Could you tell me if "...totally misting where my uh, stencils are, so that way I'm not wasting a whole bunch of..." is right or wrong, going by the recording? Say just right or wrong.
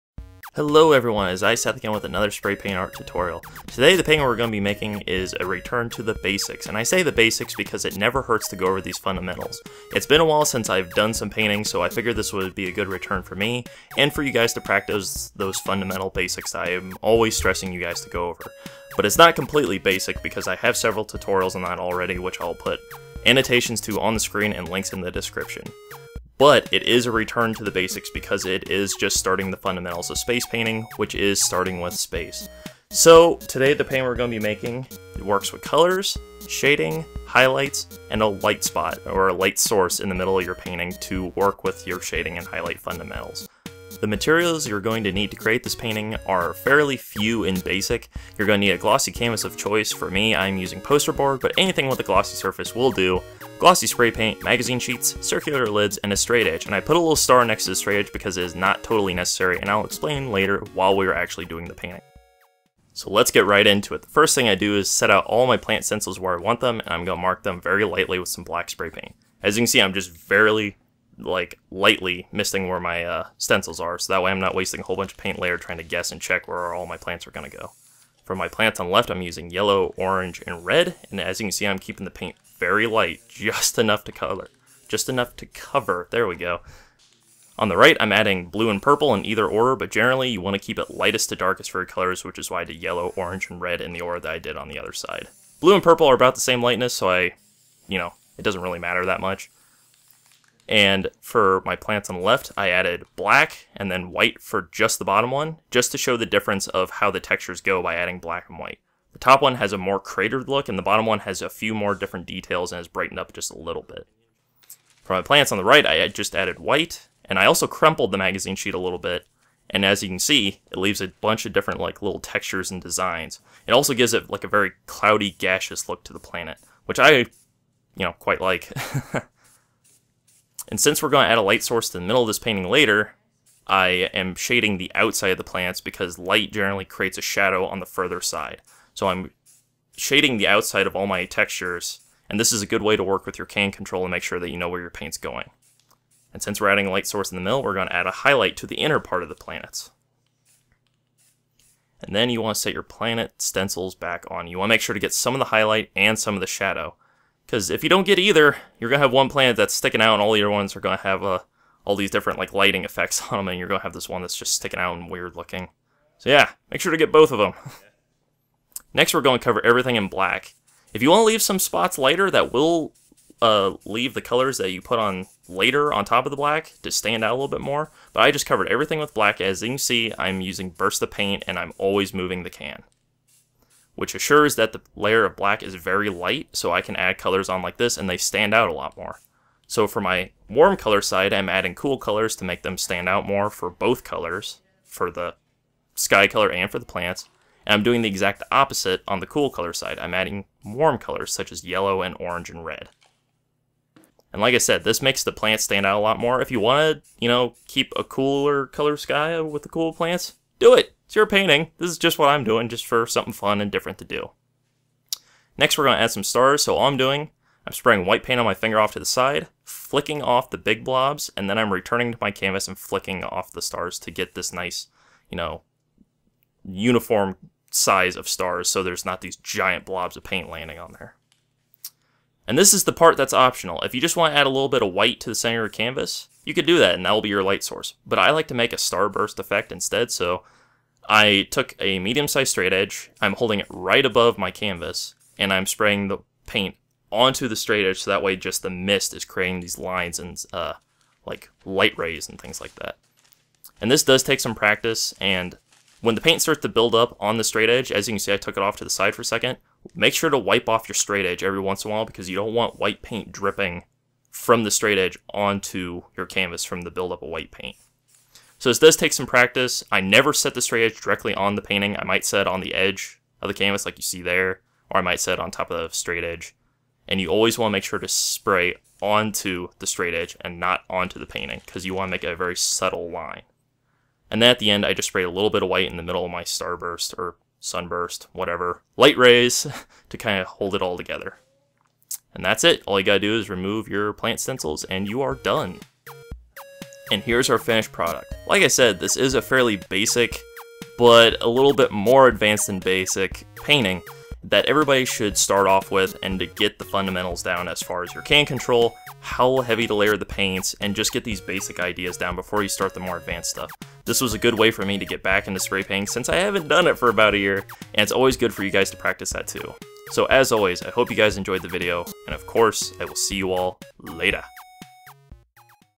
wrong.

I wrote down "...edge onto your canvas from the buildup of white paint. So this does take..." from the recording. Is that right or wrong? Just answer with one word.
right.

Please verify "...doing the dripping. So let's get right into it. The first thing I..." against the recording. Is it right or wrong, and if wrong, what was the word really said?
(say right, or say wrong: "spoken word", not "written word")
wrong: "painting", not "dripping".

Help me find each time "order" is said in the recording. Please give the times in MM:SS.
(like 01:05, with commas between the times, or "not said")
01:29, 01:34.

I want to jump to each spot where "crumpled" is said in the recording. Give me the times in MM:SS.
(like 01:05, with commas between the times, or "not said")
01:57.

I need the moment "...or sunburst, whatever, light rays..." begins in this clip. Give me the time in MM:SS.
04:47.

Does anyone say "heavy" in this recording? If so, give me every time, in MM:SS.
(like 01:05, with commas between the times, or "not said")
05:09.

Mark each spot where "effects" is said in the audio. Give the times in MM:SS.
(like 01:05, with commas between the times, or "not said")
02:42, 03:59.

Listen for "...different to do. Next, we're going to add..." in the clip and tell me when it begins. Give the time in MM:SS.
03:33.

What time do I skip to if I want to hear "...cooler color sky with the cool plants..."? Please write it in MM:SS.
03:28.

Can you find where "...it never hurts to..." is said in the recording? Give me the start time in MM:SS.
00:07.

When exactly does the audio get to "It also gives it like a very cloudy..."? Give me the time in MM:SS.
02:03.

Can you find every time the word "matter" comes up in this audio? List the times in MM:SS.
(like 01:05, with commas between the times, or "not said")
01:38.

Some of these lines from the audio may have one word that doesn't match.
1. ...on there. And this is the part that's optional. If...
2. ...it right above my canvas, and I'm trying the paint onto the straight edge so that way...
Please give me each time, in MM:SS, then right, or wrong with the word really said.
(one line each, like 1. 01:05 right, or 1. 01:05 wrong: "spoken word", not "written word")
1. 03:50 right
2. 04:03 wrong: "spraying", not "trying".